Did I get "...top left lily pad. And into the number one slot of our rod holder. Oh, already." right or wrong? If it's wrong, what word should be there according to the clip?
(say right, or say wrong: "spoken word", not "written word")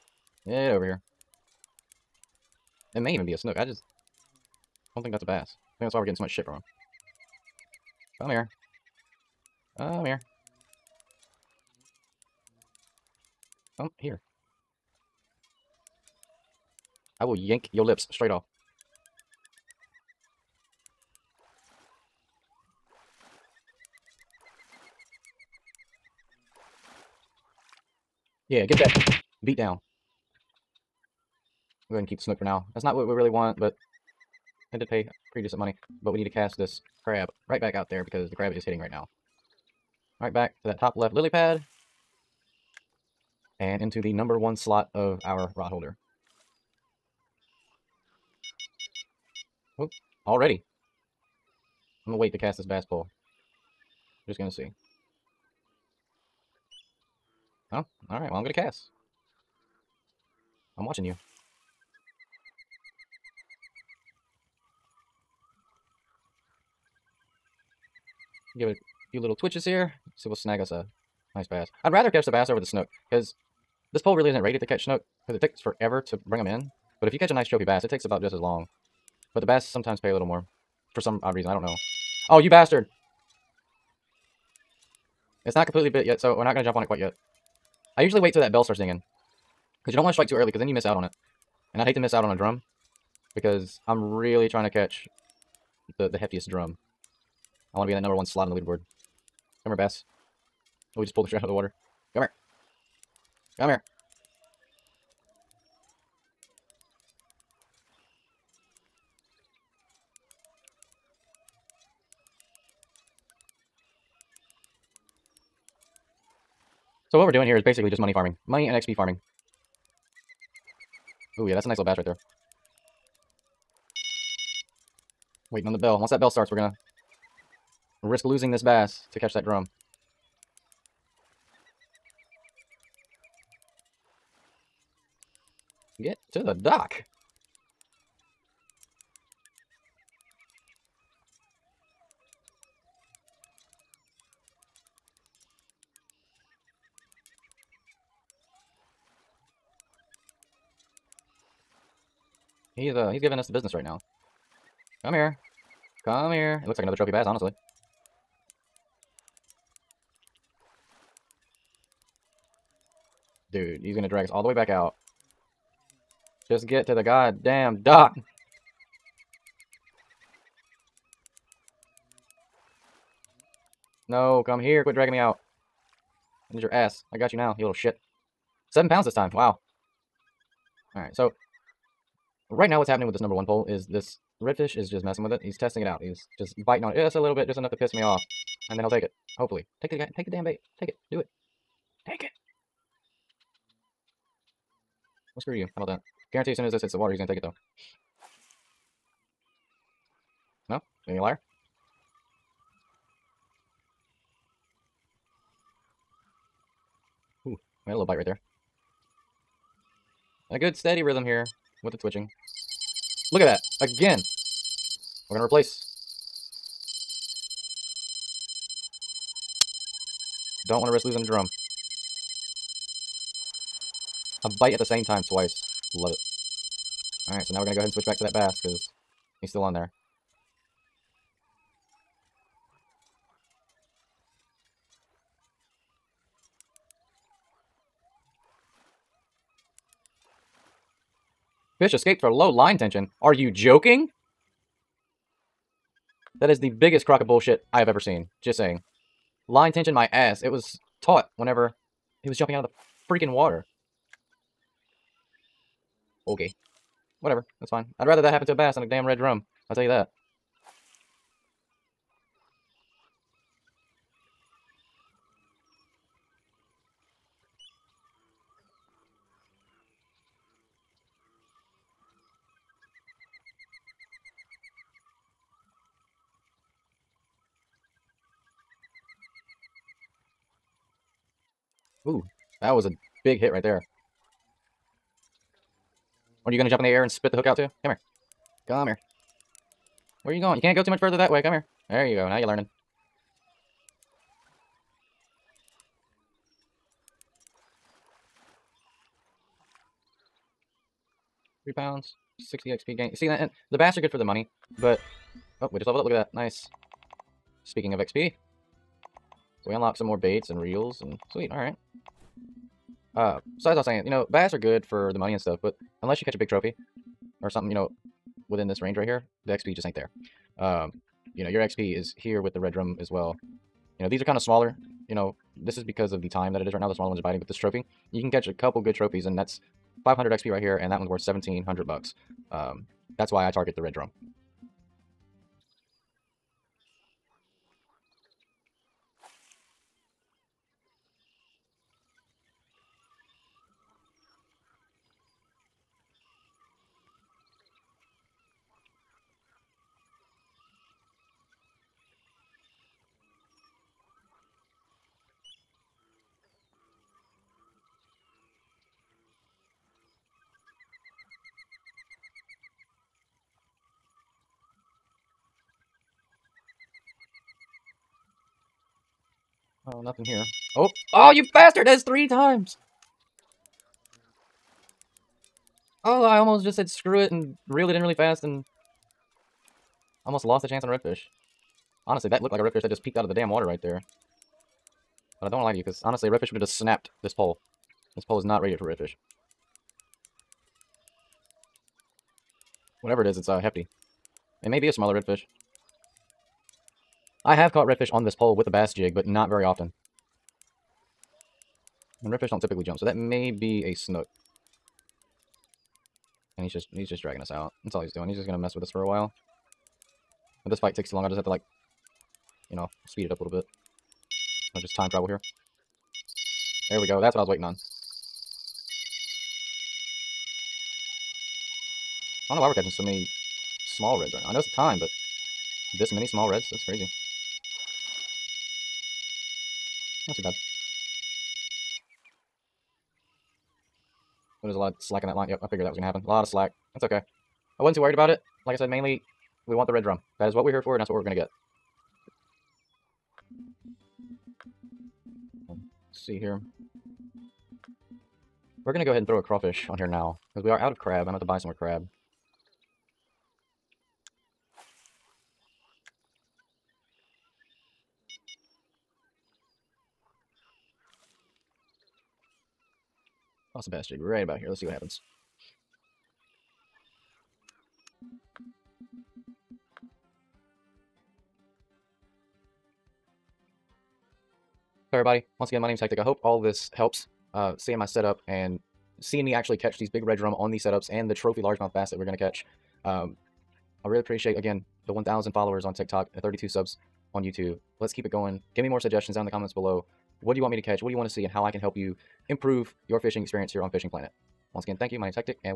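right.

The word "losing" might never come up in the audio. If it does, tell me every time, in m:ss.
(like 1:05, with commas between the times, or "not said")
2:08, 3:41.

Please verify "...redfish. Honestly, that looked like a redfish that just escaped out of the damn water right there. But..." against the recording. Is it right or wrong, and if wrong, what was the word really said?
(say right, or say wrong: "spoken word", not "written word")
wrong: "peeked", not "escaped".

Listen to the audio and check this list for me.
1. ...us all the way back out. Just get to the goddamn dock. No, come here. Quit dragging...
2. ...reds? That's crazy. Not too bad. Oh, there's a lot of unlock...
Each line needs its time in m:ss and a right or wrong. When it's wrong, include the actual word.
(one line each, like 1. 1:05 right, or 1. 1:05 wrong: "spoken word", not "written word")
1. 2:44 right
2. 7:06 wrong: "slack", not "unlock".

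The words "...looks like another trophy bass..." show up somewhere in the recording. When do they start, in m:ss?
2:36.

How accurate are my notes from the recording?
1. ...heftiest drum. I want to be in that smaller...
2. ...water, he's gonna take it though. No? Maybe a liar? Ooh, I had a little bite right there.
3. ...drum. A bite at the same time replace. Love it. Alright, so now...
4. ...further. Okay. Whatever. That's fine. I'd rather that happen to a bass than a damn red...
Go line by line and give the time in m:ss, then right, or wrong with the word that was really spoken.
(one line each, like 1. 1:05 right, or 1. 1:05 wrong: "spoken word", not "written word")
1. 1:36 wrong: "number", not "smaller"
2. 3:16 right
3. 3:41 wrong: "twice", not "replace"
4. 4:13 wrong: "water", not "further".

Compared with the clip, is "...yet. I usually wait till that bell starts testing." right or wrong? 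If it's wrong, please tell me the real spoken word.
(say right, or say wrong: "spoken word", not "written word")
wrong: "dinging", not "testing".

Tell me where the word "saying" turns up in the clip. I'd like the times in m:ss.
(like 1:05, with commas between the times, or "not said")
4:08, 5:13.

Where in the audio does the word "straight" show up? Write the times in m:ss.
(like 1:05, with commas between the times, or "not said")
0:18, 1:41.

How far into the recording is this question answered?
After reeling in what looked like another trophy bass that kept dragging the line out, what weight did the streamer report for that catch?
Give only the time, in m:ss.
2:58.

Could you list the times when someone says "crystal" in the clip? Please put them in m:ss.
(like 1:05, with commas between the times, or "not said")
not said.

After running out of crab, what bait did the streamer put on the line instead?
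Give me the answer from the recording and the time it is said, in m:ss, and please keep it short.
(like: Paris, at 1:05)
Crawfish, at 7:29.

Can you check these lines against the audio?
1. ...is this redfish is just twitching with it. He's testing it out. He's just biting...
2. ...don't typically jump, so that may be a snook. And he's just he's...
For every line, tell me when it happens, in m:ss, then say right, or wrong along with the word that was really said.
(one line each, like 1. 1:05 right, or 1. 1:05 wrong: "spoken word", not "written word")
1. 3:03 wrong: "messing", not "twitching"
2. 6:42 right.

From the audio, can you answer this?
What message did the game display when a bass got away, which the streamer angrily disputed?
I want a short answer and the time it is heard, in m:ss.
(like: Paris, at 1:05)
Low line tension, at 4:02.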